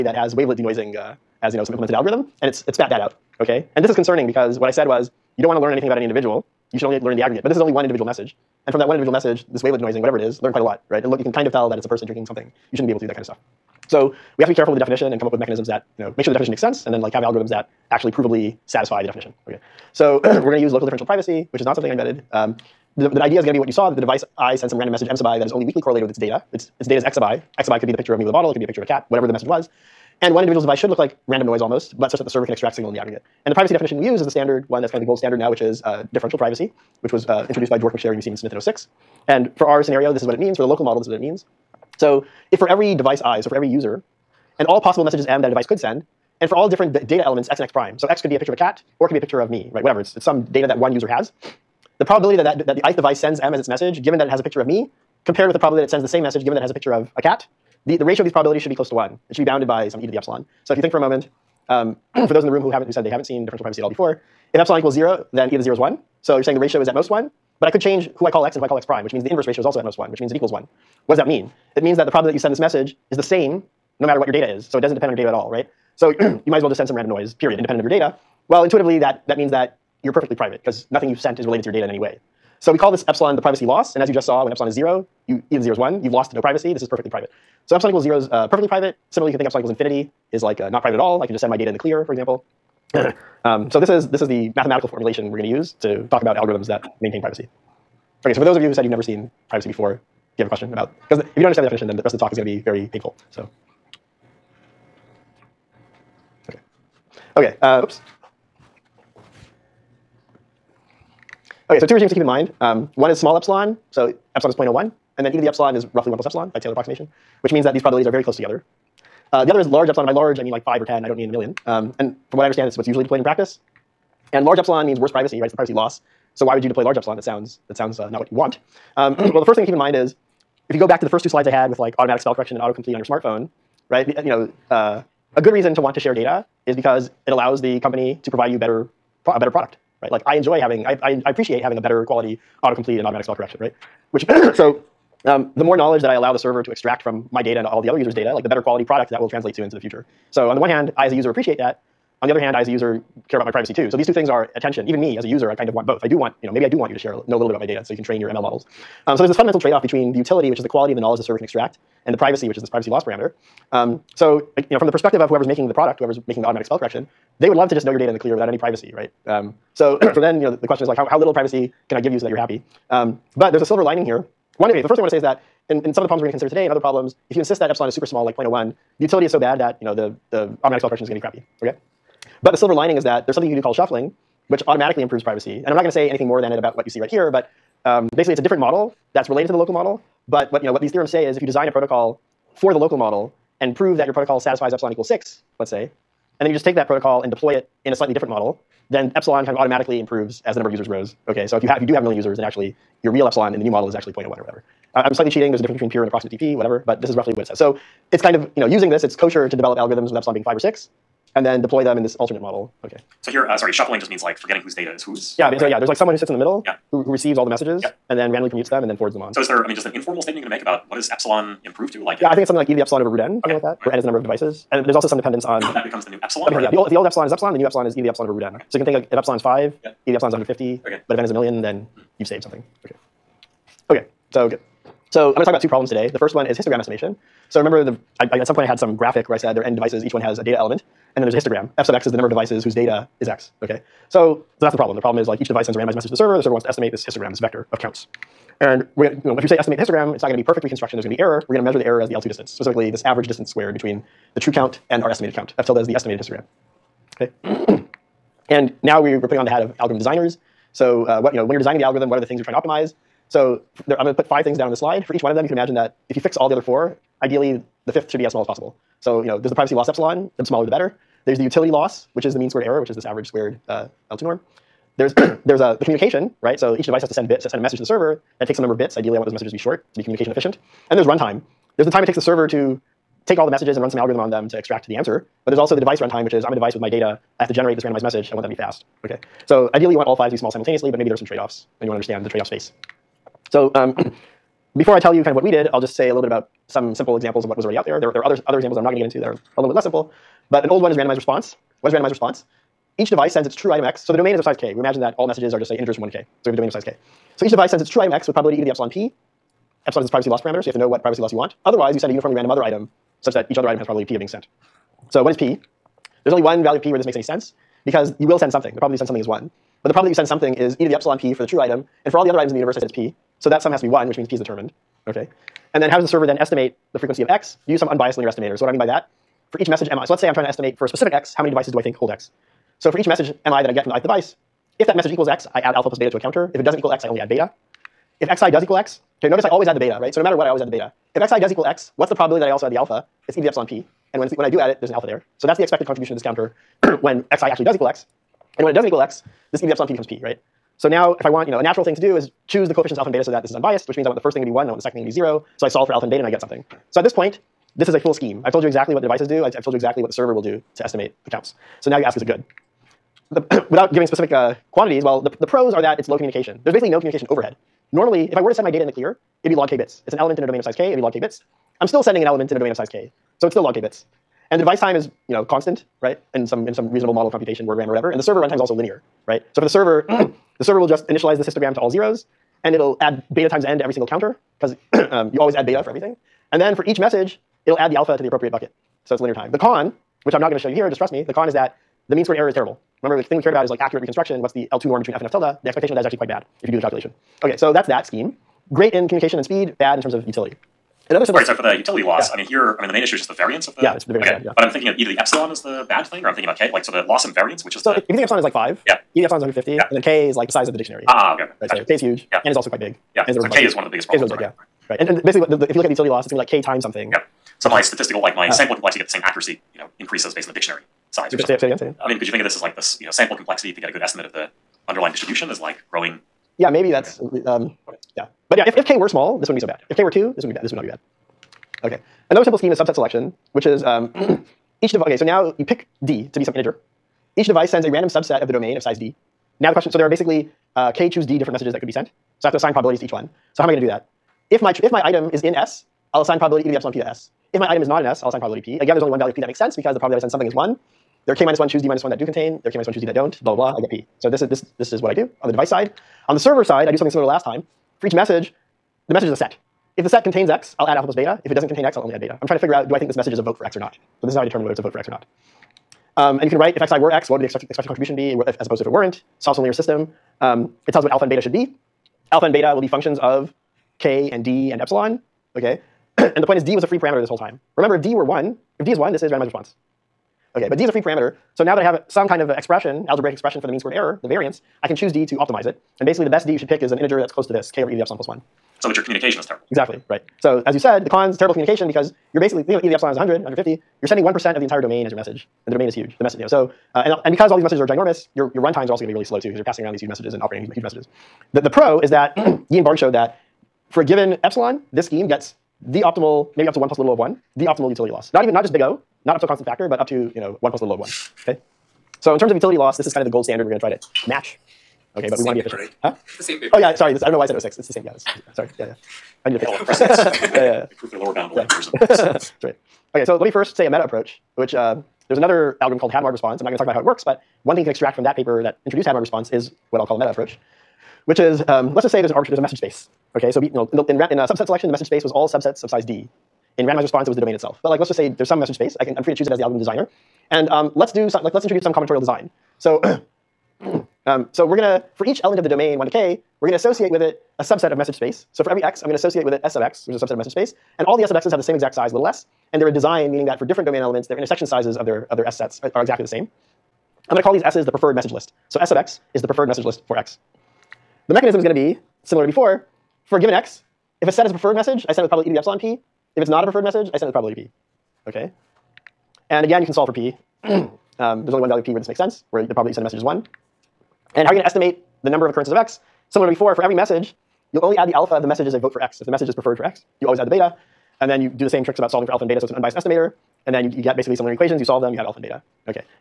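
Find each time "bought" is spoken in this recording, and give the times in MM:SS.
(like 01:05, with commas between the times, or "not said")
not said.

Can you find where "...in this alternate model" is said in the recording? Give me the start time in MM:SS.
03:31.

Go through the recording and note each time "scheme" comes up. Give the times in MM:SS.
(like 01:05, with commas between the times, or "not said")
05:58, 06:38, 07:12, 08:25.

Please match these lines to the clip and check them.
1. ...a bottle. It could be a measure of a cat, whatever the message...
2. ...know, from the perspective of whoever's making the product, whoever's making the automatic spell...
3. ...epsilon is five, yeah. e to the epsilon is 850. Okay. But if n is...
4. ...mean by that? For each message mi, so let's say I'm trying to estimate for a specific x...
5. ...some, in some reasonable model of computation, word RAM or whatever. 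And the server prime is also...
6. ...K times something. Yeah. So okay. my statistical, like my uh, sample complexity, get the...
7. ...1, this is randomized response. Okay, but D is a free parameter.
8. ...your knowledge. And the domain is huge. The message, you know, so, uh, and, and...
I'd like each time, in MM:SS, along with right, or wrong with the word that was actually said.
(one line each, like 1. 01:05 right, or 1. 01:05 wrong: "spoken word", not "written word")
1. 00:28 wrong: "picture", not "measure"
2. 02:44 right
3. 03:49 wrong: "150", not "850"
4. 05:28 right
5. 06:16 wrong: "runtime", not "prime"
6. 06:56 right
7. 07:58 right
8. 08:15 wrong: "message", not "knowledge".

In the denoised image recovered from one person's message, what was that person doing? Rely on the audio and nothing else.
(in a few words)
drinking something.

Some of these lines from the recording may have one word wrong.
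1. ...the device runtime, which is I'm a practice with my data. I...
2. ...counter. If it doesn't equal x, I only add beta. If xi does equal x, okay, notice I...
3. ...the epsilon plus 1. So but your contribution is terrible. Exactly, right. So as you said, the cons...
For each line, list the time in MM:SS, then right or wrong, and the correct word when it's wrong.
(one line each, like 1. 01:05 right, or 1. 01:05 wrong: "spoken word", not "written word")
1. 04:45 wrong: "device", not "practice"
2. 05:36 right
3. 08:07 wrong: "communication", not "contribution".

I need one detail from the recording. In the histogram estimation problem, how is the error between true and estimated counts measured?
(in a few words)
L2 distance.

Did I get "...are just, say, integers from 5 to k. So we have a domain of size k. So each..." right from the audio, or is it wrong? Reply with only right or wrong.
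wrong.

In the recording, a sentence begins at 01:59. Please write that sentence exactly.
Uh, the other is large epsilon, and by large I mean like 5 or 10, I don't mean a million.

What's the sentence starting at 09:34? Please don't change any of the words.
And how are you going to estimate the number of occurrences of x?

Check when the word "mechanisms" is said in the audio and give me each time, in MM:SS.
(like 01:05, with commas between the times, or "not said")
00:15, 09:21.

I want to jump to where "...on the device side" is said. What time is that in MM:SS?
07:35.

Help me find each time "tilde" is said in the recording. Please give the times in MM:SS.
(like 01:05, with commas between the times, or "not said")
04:15, 06:35.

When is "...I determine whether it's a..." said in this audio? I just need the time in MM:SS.
07:44.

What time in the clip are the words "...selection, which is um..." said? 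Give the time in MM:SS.
07:12.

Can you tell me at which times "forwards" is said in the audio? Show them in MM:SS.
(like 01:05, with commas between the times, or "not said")
03:38.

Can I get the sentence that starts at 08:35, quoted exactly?
Okay, but we want to be paper, efficient.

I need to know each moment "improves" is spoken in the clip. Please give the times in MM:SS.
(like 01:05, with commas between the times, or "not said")
03:05, 03:19, 03:41, 08:40.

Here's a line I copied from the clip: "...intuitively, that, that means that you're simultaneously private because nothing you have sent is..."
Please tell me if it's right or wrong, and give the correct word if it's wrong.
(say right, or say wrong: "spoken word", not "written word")
wrong: "perfectly", not "simultaneously".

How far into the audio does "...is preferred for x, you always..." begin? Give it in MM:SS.
09:39.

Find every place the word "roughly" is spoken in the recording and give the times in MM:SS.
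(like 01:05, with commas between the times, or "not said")
01:55, 03:27.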